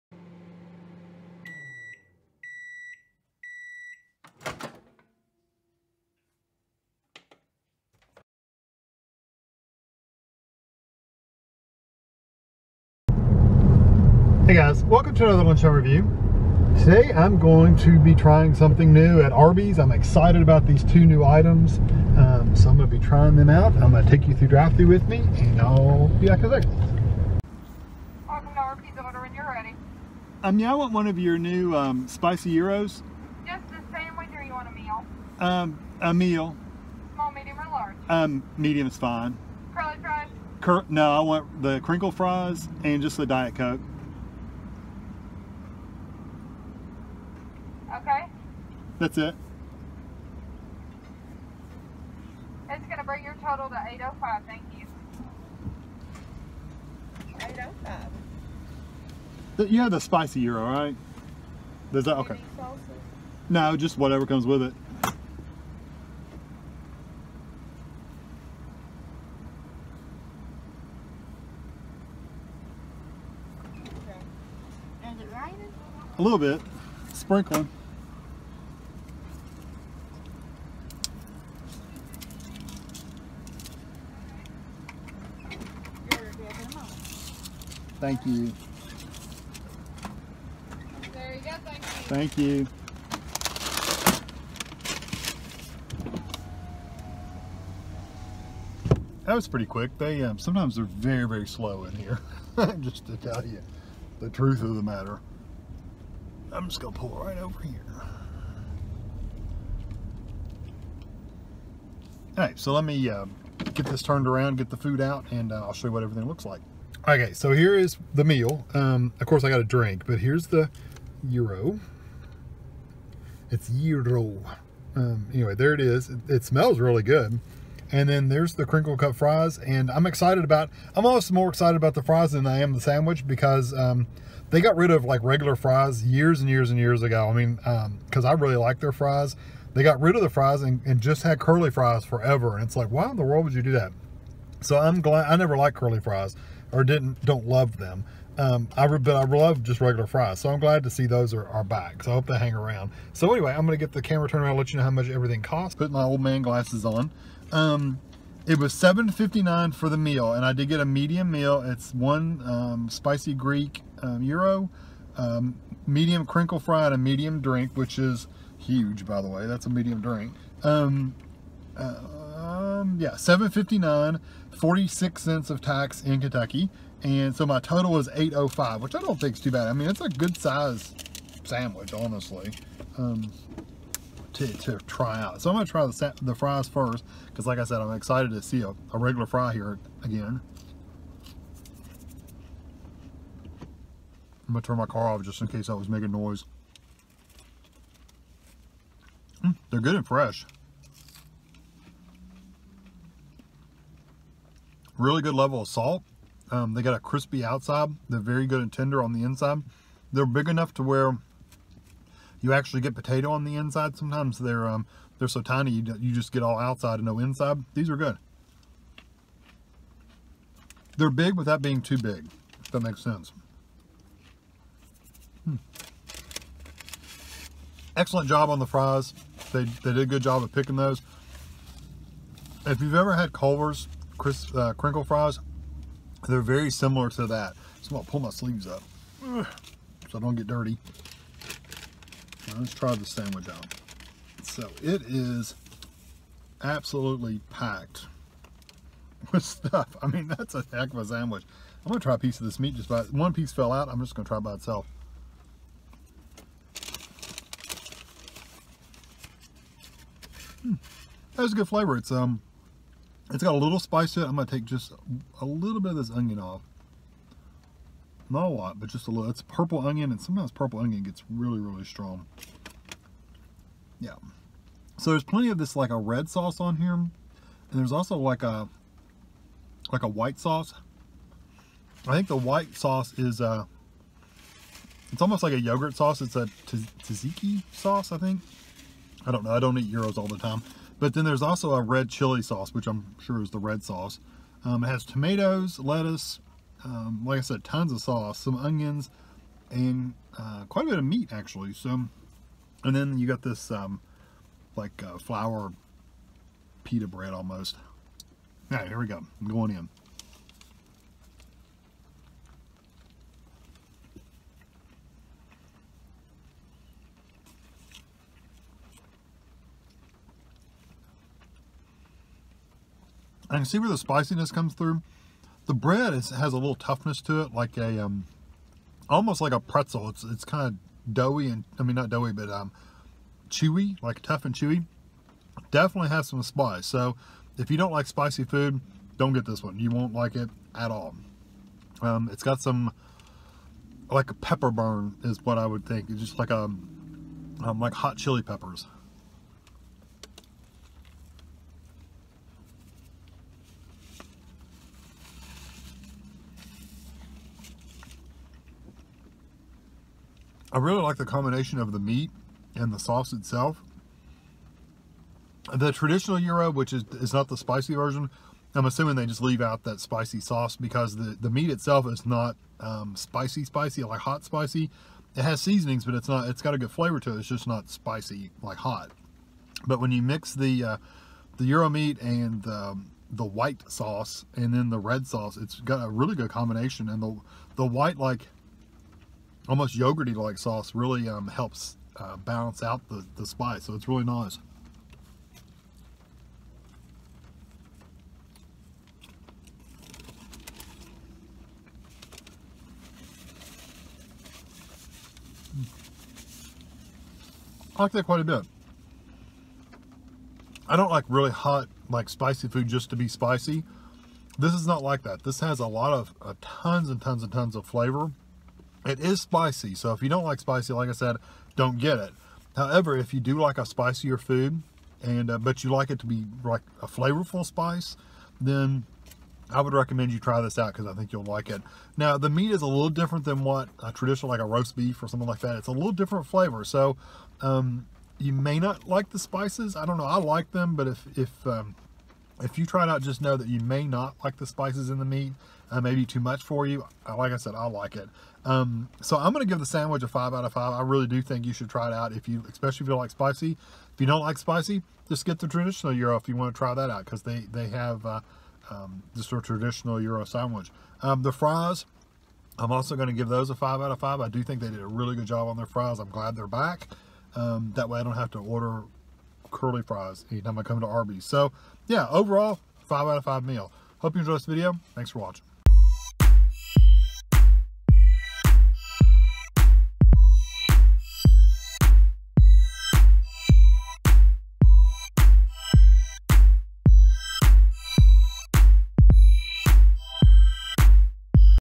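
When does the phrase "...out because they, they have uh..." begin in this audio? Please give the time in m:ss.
7:37.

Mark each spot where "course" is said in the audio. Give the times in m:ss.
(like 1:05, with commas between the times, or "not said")
1:59.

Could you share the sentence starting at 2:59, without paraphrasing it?
I mean, it's a good size sandwich, honestly, um, to, to try out.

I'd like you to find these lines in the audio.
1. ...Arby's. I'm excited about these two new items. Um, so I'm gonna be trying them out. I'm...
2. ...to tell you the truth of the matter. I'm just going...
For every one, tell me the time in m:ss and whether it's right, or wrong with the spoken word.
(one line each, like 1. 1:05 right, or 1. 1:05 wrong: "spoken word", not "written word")
1. 0:19 right
2. 1:43 right.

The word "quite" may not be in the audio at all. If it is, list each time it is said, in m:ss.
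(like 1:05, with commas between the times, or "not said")
5:00, 6:48.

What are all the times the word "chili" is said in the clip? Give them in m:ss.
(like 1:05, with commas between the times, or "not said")
4:52, 5:48.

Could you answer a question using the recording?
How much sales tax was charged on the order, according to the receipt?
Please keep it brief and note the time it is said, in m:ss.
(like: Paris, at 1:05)
46 cents, at 2:54.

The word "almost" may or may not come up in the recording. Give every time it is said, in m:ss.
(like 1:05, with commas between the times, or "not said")
2:11, 4:45, 5:07, 5:29, 6:29.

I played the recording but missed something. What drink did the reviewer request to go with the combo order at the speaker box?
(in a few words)
Diet Coke.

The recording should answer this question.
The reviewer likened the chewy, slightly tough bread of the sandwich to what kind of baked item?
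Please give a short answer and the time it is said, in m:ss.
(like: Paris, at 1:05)
A pretzel, at 5:29.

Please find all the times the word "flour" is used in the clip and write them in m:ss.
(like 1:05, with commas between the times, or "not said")
5:05.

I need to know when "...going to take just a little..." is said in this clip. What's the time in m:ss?
4:24.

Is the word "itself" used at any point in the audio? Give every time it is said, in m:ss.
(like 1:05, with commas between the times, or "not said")
4:14, 6:03, 6:11.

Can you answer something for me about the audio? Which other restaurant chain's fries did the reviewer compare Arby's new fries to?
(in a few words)
Culver's.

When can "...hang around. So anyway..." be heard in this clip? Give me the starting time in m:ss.
2:32.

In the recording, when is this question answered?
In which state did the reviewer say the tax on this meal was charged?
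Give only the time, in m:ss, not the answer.
2:56.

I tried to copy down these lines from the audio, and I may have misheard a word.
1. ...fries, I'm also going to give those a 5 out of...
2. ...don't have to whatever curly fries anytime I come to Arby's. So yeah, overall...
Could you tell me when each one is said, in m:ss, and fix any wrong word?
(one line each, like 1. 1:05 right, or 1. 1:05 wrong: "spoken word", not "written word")
1. 7:41 right
2. 7:48 wrong: "order", not "whatever".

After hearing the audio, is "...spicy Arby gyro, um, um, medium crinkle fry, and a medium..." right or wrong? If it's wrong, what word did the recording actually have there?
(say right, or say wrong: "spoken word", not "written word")
wrong: "Greek", not "Arby".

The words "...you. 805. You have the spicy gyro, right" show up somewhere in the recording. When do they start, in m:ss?
0:54.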